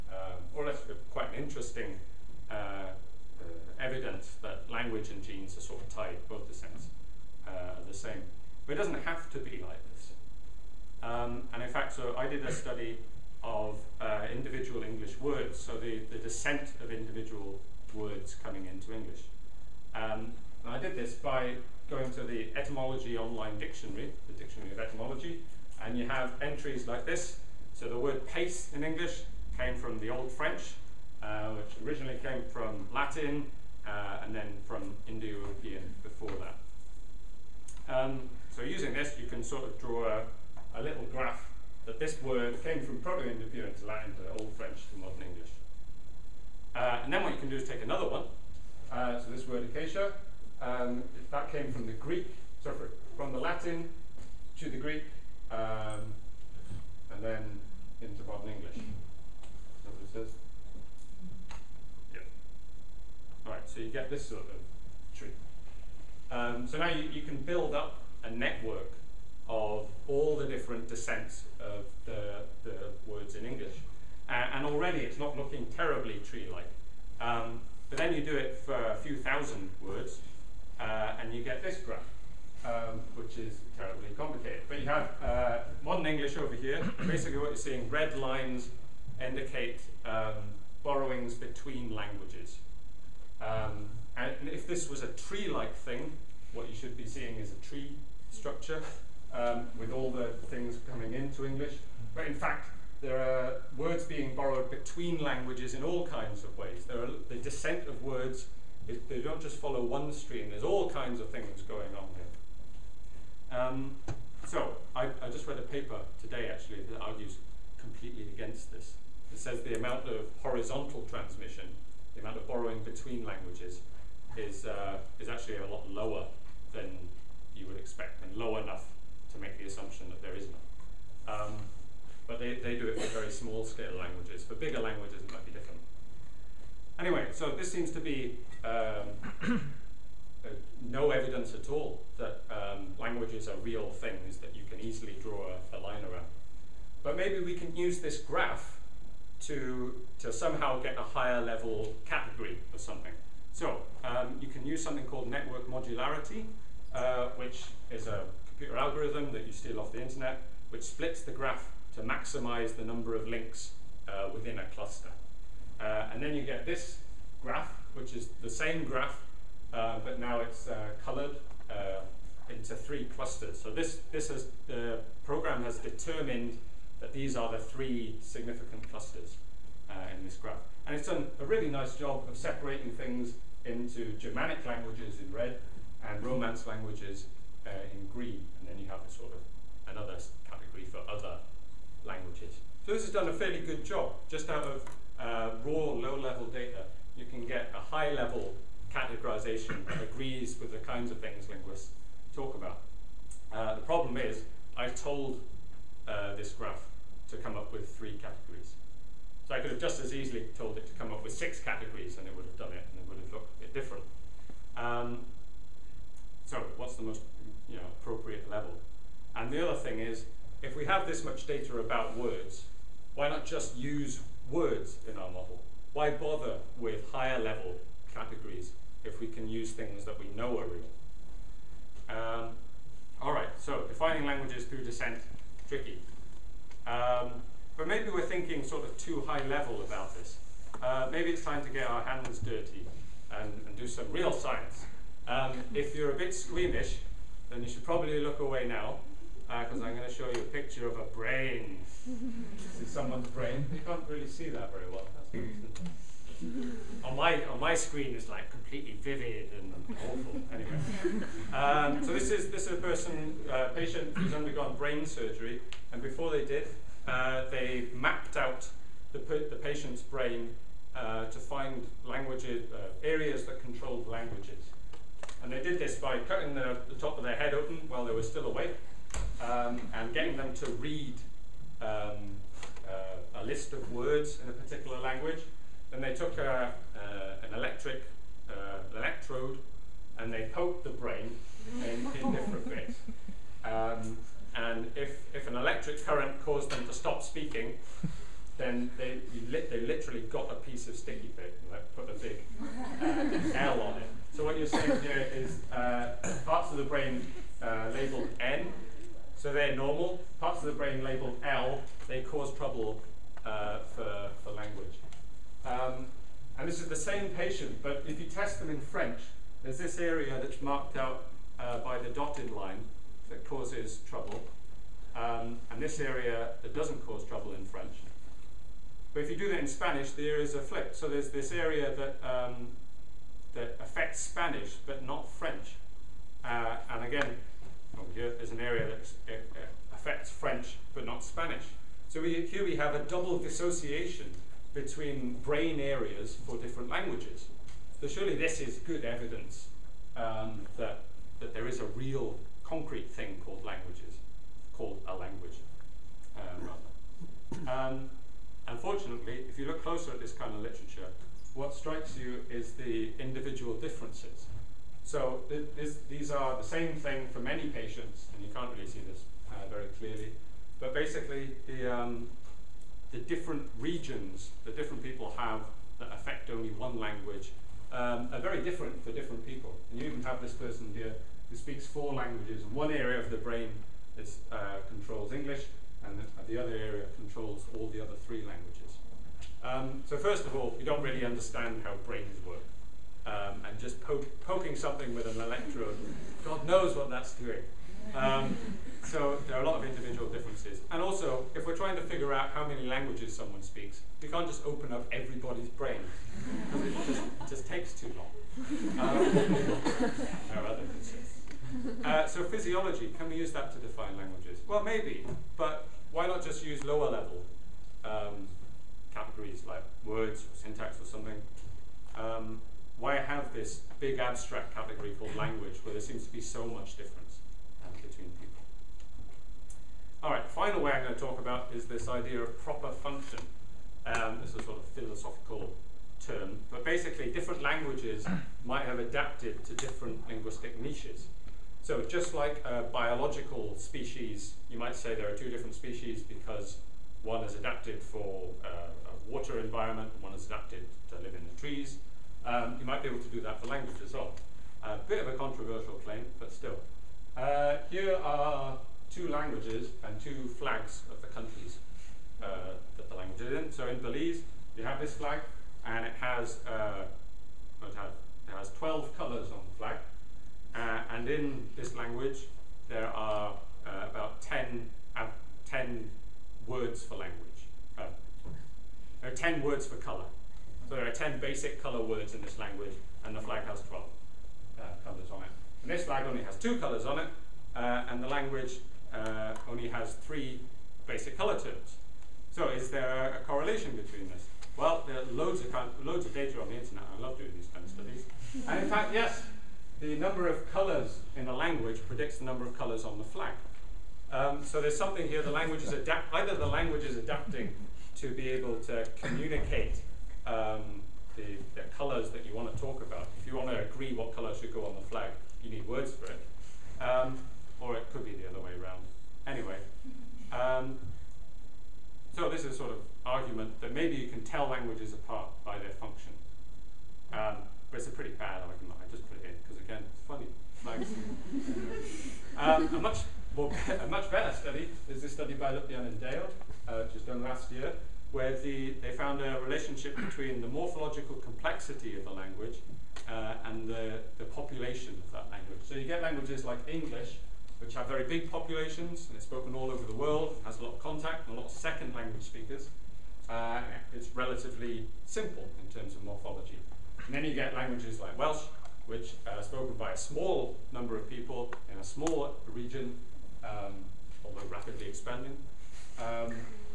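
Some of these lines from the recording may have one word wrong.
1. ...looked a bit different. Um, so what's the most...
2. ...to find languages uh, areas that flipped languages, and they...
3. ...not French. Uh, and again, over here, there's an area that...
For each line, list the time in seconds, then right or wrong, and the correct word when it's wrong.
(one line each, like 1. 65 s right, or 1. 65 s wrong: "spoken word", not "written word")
1. 213 s right
2. 271 s wrong: "controlled", not "flipped"
3. 335 s right.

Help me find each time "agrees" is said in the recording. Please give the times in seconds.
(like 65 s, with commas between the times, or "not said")
200 s, 513 s.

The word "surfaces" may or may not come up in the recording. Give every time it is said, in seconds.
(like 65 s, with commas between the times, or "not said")
60 s.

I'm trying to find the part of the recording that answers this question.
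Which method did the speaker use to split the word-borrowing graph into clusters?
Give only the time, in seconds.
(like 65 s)
155 s.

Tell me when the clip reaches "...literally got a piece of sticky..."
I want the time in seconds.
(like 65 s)
299 s.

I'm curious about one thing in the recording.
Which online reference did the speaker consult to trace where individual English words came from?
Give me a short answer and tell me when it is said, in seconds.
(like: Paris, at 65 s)
Etymology Online Dictionary, at 22 s.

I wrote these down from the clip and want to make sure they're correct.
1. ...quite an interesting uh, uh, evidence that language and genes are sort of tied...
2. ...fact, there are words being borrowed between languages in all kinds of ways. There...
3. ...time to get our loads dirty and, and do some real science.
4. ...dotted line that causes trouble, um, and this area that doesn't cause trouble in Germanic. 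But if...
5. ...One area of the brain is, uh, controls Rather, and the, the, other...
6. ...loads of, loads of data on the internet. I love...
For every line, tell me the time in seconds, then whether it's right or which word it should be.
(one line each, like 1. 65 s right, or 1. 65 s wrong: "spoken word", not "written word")
1. 1 s right
2. 102 s right
3. 241 s wrong: "hands", not "loads"
4. 322 s wrong: "French", not "Germanic"
5. 382 s wrong: "English", not "Rather"
6. 495 s right.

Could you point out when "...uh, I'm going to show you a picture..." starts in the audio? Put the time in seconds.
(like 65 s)
249 s.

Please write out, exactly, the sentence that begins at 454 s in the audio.
A bit of a controversial claim, but still.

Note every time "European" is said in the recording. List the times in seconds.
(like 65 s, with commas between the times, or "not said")
35 s, 42 s.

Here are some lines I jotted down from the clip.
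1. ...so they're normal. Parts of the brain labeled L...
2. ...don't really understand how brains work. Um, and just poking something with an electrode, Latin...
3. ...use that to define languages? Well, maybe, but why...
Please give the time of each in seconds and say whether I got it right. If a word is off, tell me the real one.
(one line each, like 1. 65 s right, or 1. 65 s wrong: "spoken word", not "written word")
1. 309 s right
2. 390 s wrong: "God", not "Latin"
3. 413 s right.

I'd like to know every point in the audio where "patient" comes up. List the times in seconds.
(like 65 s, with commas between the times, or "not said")
263 s, 269 s, 317 s, 367 s.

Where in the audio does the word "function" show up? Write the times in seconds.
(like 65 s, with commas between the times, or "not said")
432 s, 525 s.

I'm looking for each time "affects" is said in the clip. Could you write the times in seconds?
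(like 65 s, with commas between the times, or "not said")
333 s, 339 s, 376 s.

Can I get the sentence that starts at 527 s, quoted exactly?
Um, but it's a pretty bad argument.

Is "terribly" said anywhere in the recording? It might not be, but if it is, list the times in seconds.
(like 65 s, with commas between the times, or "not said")
75 s, 83 s.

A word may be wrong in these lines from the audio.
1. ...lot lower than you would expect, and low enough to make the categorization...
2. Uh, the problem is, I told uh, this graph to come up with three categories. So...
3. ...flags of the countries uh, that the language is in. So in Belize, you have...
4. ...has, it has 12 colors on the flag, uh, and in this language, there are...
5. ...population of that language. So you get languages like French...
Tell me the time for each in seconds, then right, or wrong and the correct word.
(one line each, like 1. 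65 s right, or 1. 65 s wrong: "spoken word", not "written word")
1. 125 s wrong: "assumption", not "categorization"
2. 203 s right
3. 460 s right
4. 467 s right
5. 544 s wrong: "English", not "French".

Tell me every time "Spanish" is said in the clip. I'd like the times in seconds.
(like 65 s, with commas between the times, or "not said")
329 s, 334 s, 341 s.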